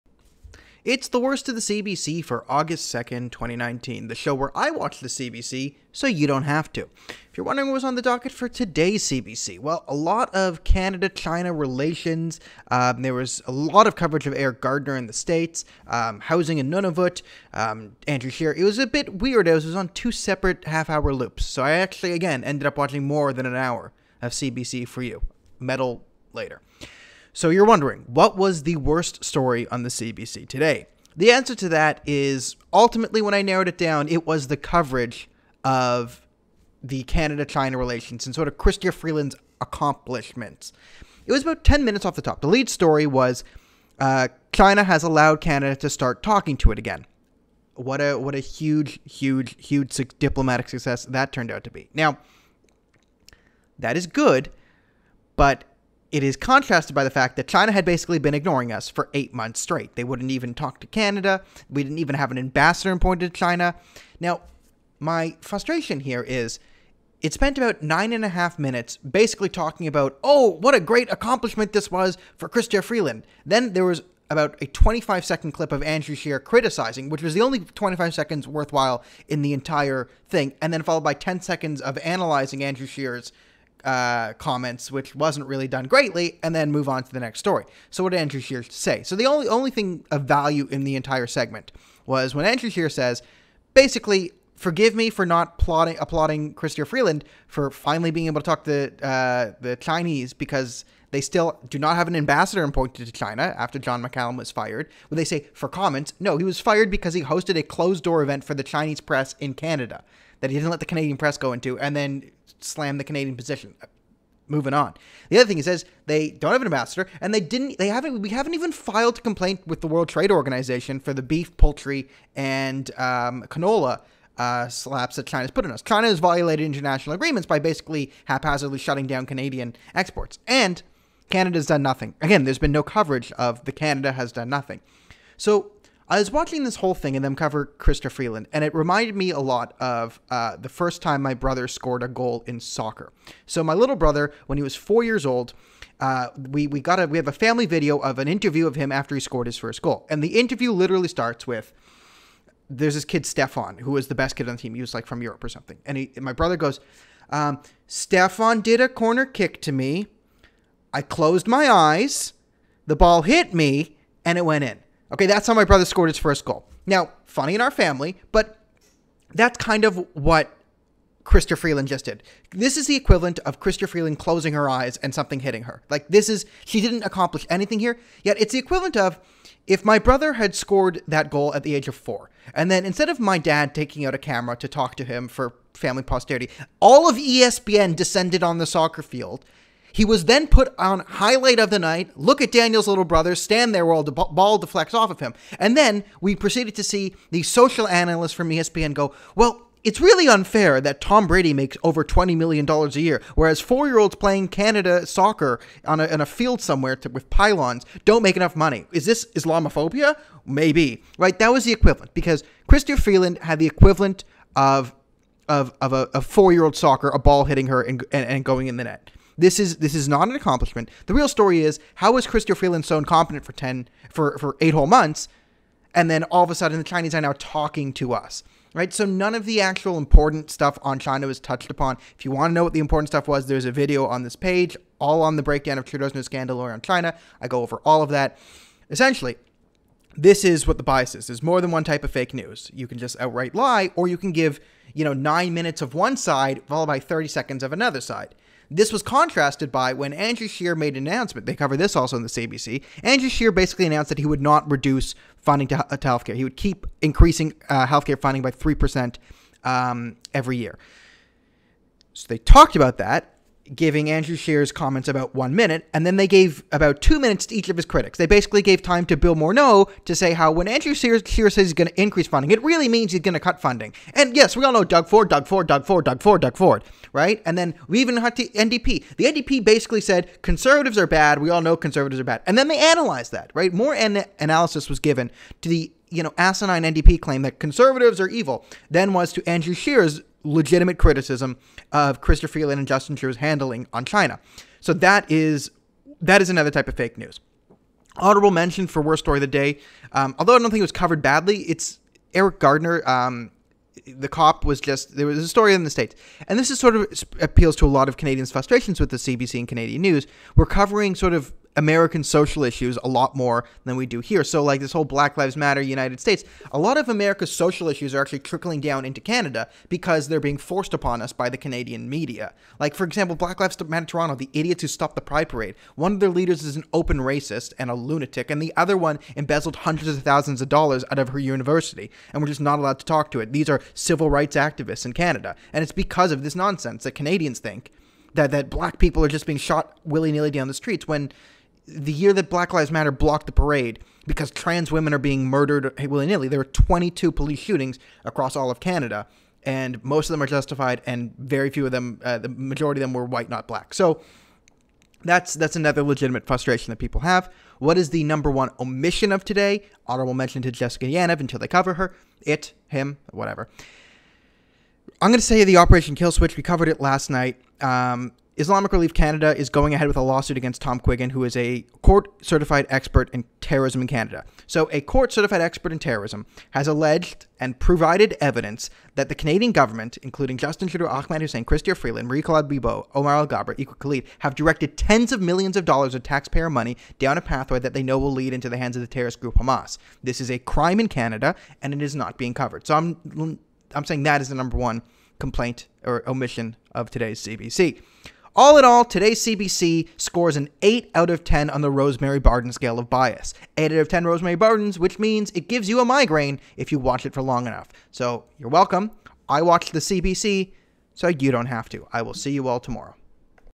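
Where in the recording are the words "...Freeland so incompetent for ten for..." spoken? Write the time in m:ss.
3:42.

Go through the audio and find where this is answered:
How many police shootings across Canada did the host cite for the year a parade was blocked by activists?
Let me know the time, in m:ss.
5:46.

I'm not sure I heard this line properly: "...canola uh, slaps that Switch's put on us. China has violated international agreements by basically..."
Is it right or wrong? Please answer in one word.
wrong.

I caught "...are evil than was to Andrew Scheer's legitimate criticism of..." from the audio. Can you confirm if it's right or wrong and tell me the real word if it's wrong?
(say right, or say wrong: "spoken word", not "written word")
right.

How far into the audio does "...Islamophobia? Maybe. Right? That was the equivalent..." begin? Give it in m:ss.
3:29.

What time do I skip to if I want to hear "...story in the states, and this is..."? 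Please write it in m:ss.
5:05.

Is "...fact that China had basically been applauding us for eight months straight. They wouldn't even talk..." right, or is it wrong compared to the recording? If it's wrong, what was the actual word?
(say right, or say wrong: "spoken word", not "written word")
wrong: "ignoring", not "applauding".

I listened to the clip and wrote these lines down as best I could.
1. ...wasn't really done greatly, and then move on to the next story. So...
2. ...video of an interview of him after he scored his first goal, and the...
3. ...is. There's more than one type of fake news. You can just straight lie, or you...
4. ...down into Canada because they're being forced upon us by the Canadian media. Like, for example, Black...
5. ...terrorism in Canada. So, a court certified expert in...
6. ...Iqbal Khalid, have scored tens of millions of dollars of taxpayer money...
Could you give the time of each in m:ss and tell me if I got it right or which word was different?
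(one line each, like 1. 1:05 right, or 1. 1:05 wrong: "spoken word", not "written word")
1. 1:25 right
2. 2:27 right
3. 4:01 wrong: "outright", not "straight"
4. 5:18 right
5. 6:13 right
6. 6:23 wrong: "directed", not "scored".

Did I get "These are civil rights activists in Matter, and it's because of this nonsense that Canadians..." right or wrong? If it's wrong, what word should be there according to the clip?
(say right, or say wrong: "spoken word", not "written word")
wrong: "Canada", not "Matter".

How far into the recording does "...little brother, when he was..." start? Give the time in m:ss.
2:23.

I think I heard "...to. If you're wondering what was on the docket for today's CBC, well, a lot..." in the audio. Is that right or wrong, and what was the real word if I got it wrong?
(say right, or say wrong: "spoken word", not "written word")
right.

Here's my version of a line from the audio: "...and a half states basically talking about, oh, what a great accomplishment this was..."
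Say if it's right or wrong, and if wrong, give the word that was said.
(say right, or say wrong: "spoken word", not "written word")
wrong: "minutes", not "states".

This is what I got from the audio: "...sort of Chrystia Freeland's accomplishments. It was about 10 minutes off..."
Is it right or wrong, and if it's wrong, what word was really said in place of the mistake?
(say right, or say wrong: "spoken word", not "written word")
right.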